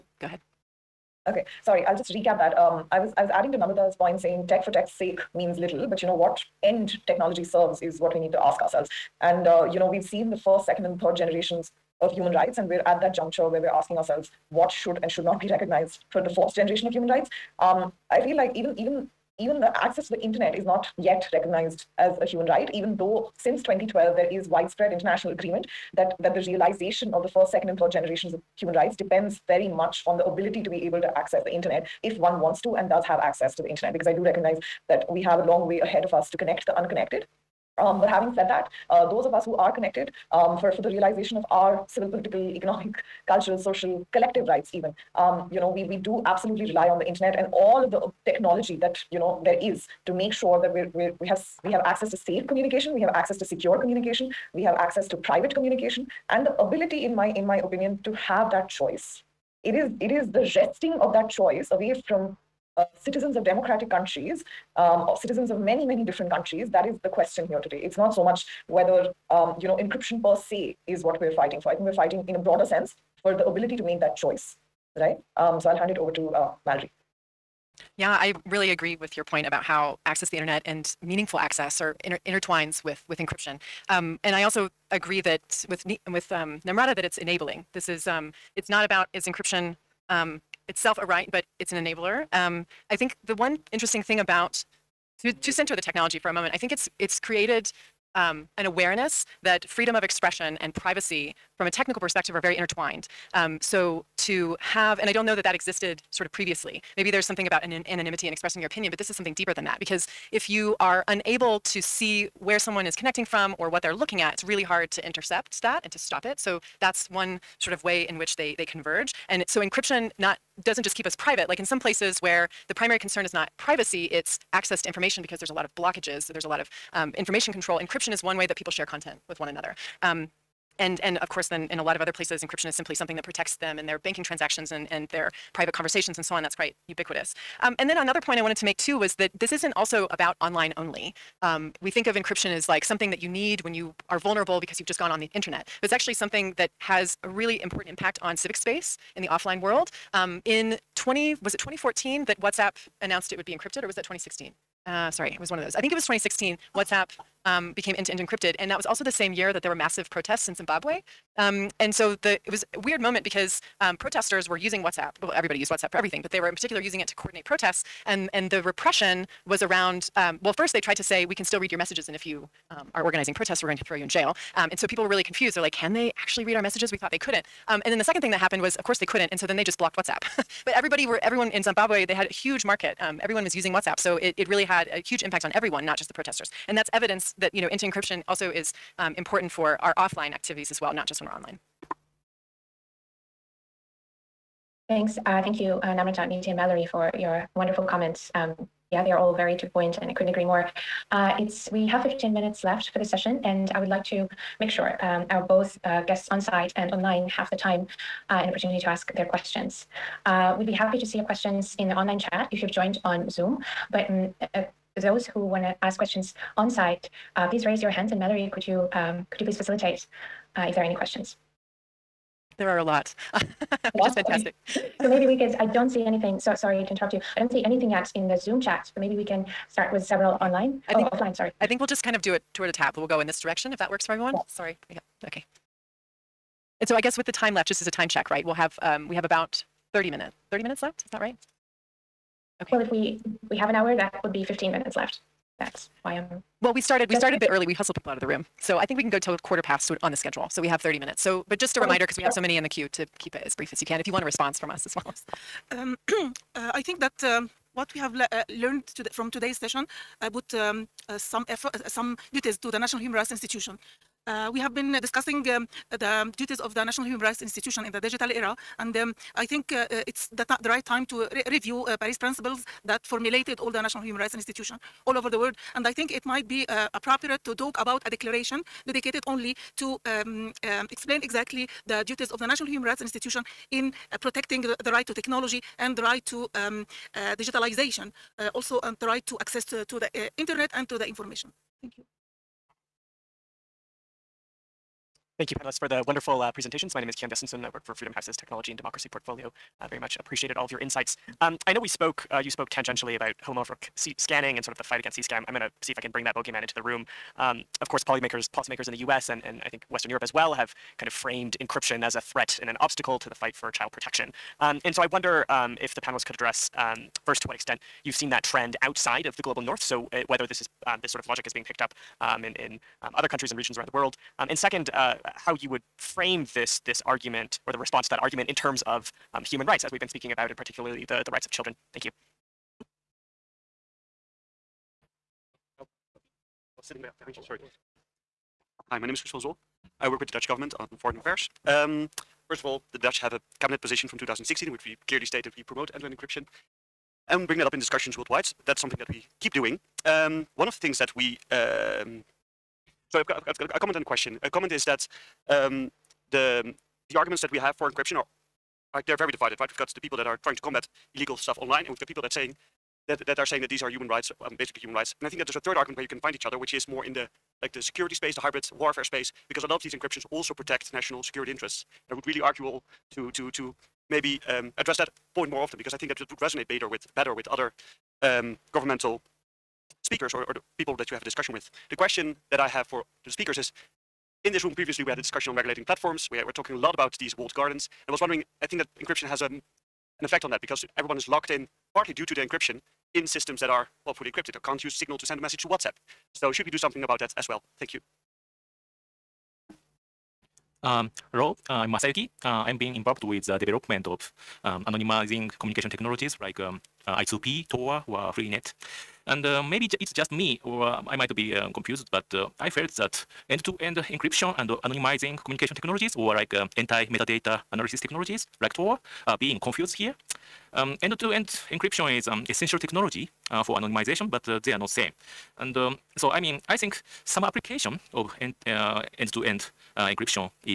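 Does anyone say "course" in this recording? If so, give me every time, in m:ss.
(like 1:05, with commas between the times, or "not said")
2:11, 2:58, 5:07.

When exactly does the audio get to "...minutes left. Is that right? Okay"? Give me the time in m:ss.
4:00.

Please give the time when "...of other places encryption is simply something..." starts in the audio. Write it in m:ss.
2:11.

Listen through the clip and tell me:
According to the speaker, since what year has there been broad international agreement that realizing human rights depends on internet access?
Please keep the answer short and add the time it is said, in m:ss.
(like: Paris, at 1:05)
2012, at 0:23.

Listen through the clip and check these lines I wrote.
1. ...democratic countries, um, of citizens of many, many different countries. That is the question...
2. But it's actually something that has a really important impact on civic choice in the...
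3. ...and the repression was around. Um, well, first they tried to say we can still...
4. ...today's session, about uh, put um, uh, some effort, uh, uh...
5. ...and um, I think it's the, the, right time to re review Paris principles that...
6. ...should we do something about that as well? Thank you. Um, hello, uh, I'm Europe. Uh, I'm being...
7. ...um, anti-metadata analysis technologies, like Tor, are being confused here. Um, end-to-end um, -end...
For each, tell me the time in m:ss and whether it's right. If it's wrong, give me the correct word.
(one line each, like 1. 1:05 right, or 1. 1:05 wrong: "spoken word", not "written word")
1. 1:03 right
2. 2:25 wrong: "space", not "choice"
3. 2:48 right
4. 4:19 right
5. 4:28 right
6. 6:36 wrong: "Masayuki", not "Europe"
7. 6:56 right.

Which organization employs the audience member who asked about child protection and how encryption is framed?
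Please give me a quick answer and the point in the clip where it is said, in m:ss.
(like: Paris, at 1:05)
Freedom House, at 4:57.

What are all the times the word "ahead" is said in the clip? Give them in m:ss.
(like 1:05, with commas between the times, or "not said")
0:00, 0:35.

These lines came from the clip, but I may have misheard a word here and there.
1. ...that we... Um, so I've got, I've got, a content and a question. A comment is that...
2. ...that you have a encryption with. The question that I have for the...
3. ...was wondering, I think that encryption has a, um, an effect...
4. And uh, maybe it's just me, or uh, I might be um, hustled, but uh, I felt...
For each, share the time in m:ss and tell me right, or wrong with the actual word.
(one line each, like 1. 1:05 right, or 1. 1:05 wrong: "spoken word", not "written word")
1. 5:50 wrong: "comment", not "content"
2. 6:20 wrong: "discussion", not "encryption"
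3. 6:28 right
4. 6:49 wrong: "confused", not "hustled".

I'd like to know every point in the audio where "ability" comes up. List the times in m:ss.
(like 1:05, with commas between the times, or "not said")
0:30, 0:56, 1:13.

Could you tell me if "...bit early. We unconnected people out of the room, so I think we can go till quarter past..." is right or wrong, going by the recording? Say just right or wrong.
wrong.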